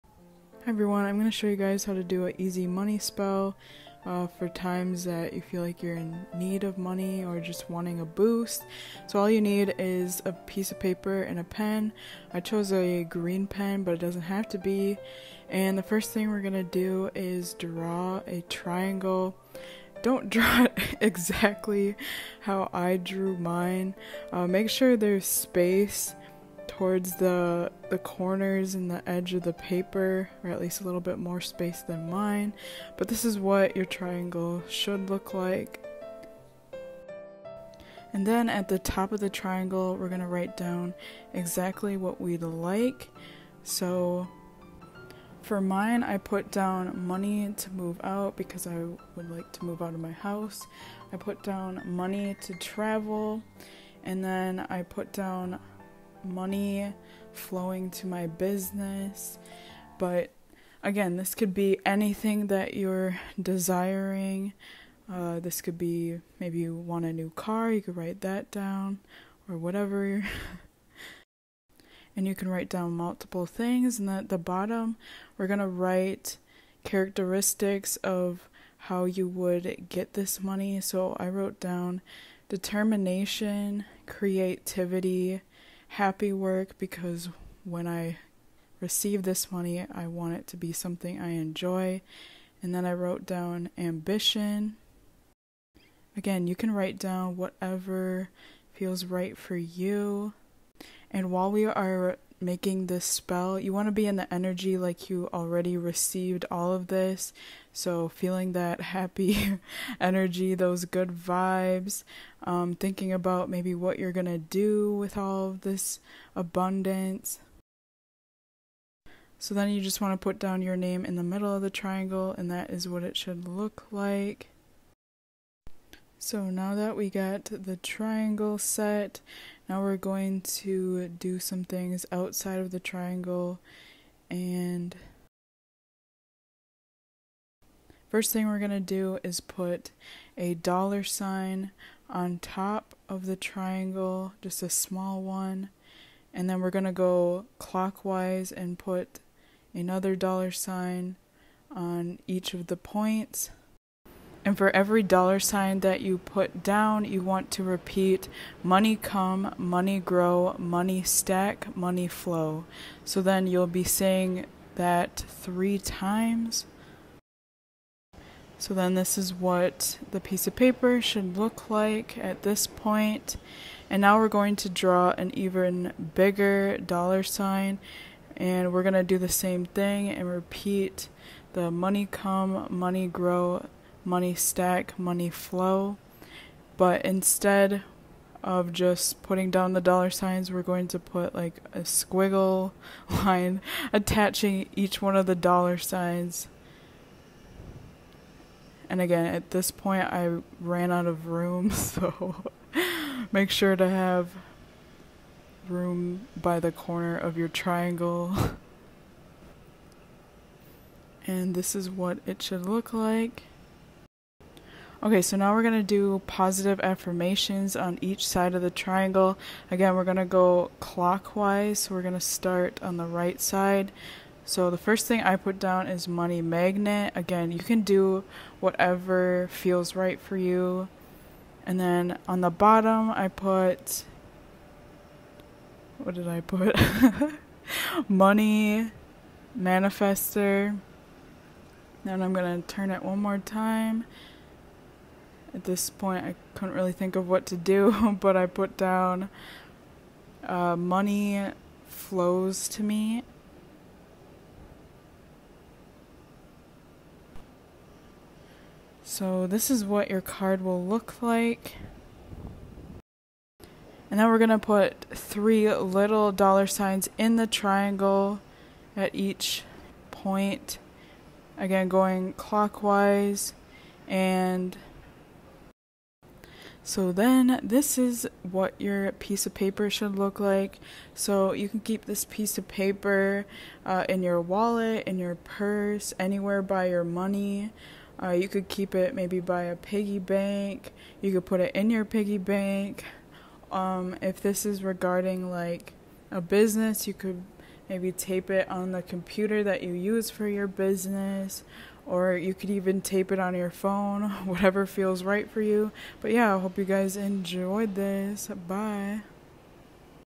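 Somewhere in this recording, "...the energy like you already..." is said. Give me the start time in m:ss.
1:44.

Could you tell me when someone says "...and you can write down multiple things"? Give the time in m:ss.
1:12.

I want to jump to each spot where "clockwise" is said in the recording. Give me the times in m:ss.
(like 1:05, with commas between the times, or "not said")
2:27, 3:40, 4:32.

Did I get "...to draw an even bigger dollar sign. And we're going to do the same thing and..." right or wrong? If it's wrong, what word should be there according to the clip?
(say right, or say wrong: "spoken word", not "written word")
right.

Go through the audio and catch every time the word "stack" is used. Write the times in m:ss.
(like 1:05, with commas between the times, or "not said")
2:41, 3:04.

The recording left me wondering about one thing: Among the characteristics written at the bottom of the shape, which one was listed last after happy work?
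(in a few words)
Ambition.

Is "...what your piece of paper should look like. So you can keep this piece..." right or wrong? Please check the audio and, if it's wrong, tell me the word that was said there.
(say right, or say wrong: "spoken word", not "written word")
right.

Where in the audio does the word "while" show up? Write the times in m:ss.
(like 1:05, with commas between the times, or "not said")
1:41.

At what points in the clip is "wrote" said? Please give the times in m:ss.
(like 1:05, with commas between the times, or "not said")
1:21, 1:32.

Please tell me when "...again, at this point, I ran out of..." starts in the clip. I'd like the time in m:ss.
3:18.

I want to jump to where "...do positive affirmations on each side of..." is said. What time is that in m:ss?
3:35.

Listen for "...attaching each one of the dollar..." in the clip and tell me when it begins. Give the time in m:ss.
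3:13.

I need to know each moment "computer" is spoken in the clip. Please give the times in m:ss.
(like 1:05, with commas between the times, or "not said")
4:59.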